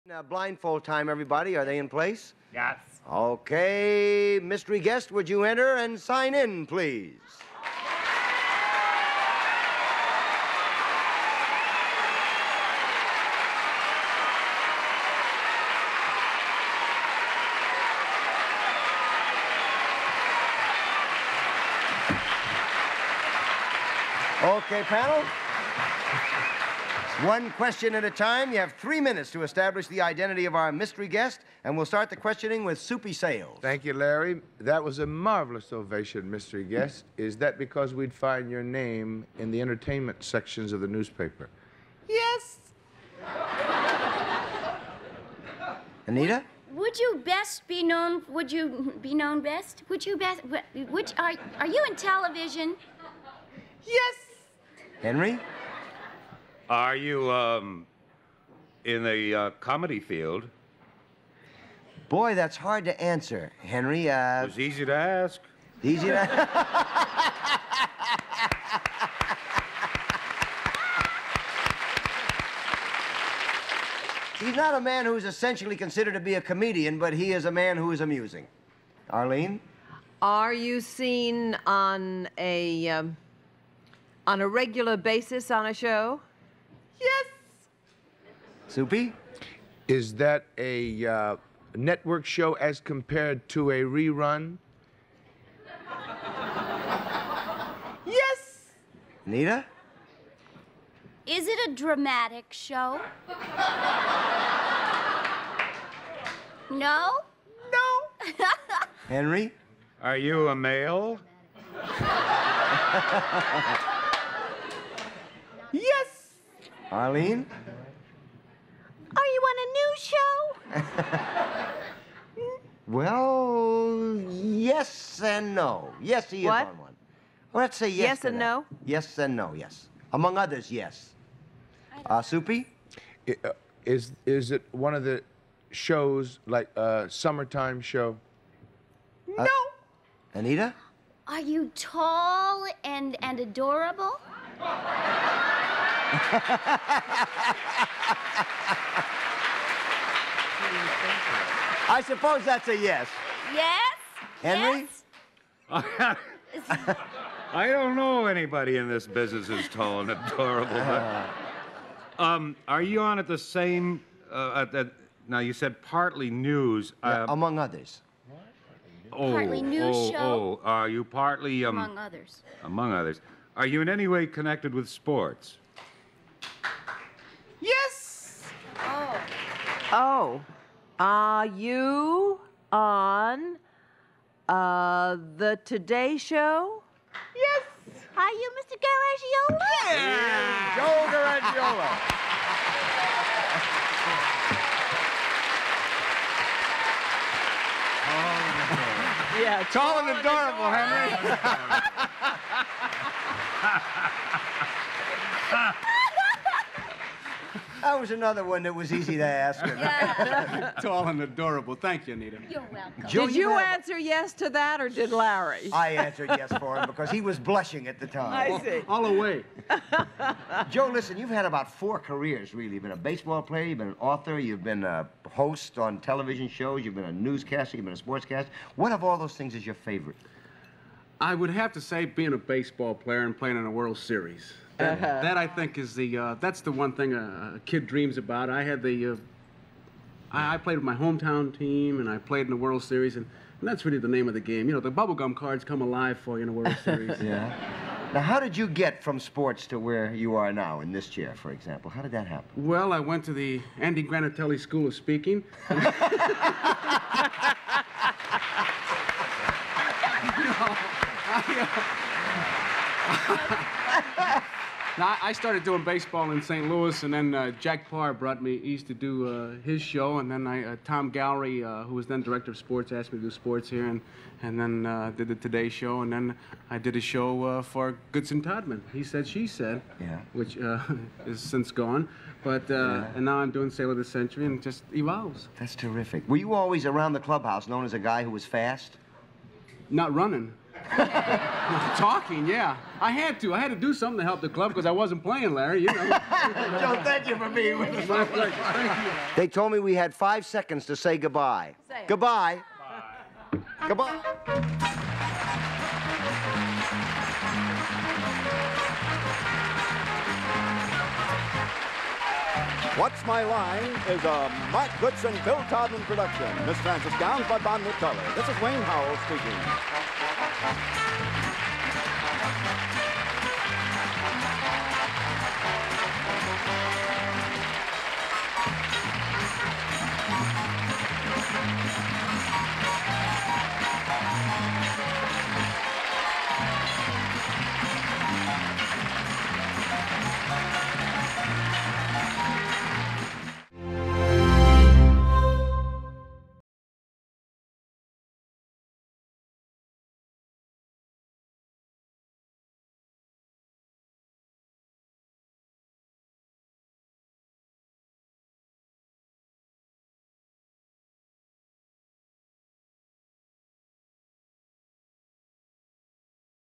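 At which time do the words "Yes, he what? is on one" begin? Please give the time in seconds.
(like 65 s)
126 s.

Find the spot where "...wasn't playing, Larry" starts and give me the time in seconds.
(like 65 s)
294 s.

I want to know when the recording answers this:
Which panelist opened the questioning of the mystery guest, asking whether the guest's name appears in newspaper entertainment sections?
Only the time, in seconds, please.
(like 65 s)
32 s.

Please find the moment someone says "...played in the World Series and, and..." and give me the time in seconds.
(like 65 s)
242 s.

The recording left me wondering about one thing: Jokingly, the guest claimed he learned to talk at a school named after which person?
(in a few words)
Andy Granatelli.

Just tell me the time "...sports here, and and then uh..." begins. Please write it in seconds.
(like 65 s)
273 s.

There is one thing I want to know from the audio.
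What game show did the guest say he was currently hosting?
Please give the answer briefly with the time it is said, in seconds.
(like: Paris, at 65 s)
Sale of the Century, at 283 s.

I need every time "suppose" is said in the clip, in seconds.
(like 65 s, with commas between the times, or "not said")
152 s.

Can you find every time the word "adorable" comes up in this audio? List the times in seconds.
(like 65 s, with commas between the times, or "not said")
143 s, 160 s, 200 s, 211 s.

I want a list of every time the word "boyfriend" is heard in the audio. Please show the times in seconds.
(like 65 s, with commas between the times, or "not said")
not said.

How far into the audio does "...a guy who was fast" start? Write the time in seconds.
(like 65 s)
287 s.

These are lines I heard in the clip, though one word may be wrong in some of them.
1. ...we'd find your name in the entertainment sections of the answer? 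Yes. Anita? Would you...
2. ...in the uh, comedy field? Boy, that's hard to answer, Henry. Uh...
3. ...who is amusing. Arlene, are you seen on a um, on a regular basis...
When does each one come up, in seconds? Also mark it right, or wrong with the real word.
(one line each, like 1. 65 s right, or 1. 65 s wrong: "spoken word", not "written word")
1. 37 s wrong: "newspaper", not "answer"
2. 58 s right
3. 77 s right.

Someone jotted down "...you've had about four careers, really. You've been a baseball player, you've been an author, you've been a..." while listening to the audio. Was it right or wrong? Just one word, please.
right.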